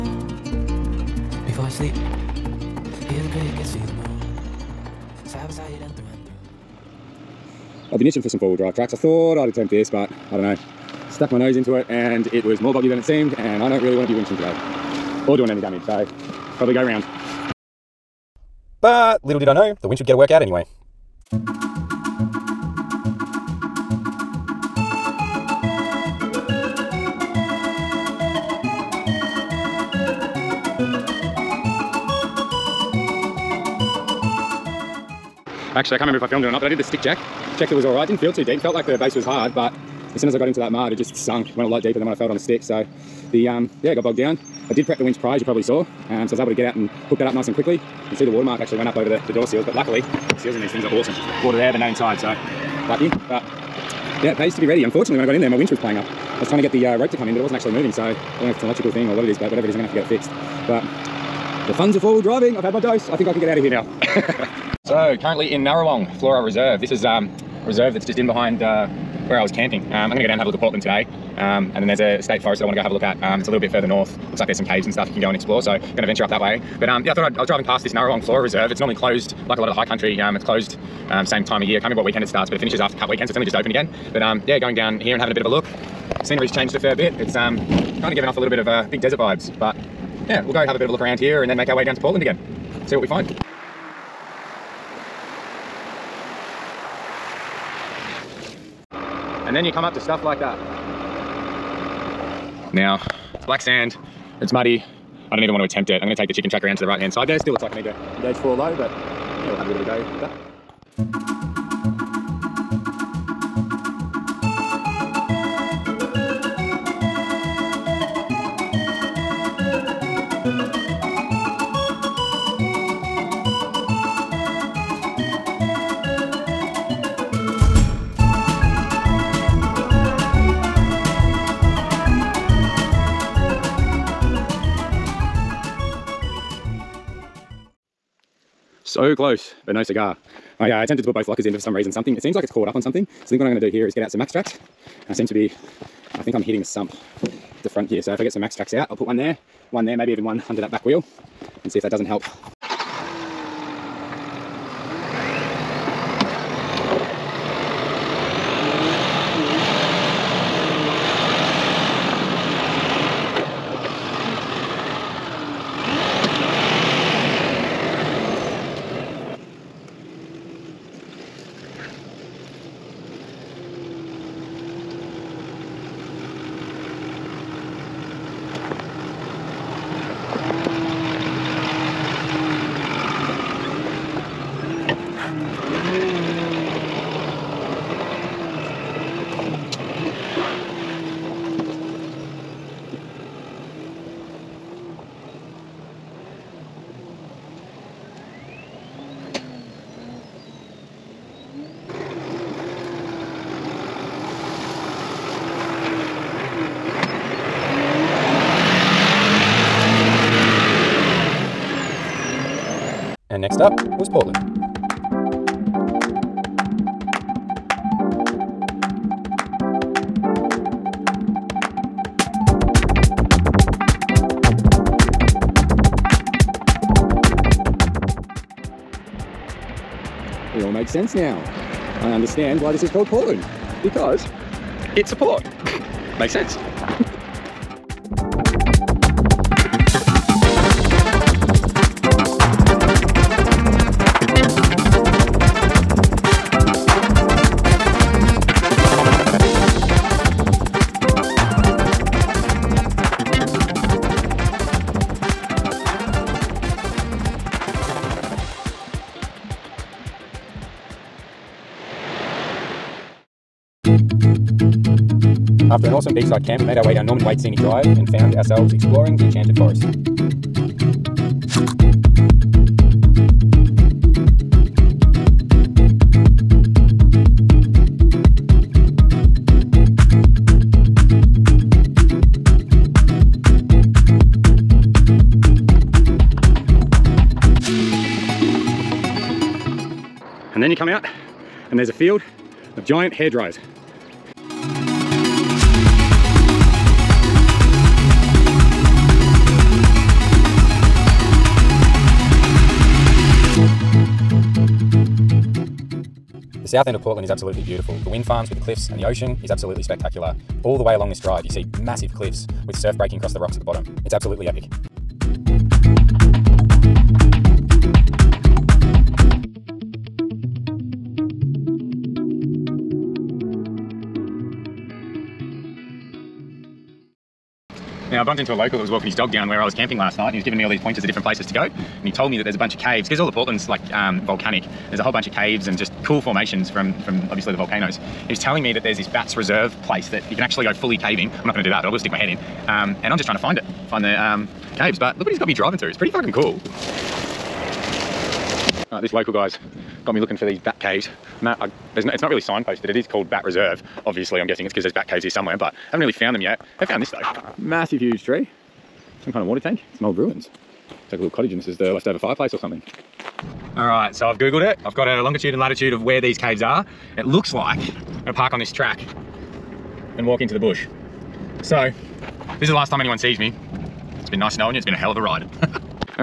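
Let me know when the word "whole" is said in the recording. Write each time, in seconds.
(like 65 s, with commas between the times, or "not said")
335 s.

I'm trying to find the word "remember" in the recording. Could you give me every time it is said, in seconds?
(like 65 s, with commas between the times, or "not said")
36 s, 81 s.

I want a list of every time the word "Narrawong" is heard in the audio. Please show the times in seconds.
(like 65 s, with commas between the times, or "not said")
65 s, 77 s.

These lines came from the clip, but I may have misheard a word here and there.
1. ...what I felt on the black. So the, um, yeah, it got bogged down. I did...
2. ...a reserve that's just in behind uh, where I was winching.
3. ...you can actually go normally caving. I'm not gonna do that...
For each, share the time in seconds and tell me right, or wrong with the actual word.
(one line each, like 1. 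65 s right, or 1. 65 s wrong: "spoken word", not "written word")
1. 42 s wrong: "stick", not "black"
2. 67 s wrong: "camping", not "winching"
3. 340 s wrong: "fully", not "normally".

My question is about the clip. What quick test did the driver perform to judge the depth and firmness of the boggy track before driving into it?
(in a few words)
stick check.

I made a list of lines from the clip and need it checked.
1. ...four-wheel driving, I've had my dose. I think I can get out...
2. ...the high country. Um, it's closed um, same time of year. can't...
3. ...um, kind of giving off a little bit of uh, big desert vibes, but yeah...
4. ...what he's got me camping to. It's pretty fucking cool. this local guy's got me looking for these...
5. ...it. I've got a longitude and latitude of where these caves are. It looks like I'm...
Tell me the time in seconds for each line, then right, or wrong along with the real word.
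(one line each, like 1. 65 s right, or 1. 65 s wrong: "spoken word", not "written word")
1. 62 s right
2. 79 s right
3. 87 s right
4. 345 s wrong: "driving", not "camping"
5. 364 s right.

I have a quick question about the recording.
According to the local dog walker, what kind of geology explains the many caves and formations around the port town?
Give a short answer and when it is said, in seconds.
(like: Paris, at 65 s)
volcanic, at 334 s.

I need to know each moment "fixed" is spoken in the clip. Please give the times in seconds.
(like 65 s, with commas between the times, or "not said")
60 s.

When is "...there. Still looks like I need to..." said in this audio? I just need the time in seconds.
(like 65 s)
107 s.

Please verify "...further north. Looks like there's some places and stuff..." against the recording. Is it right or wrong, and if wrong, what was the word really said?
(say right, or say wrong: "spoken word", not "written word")
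wrong: "caves", not "places".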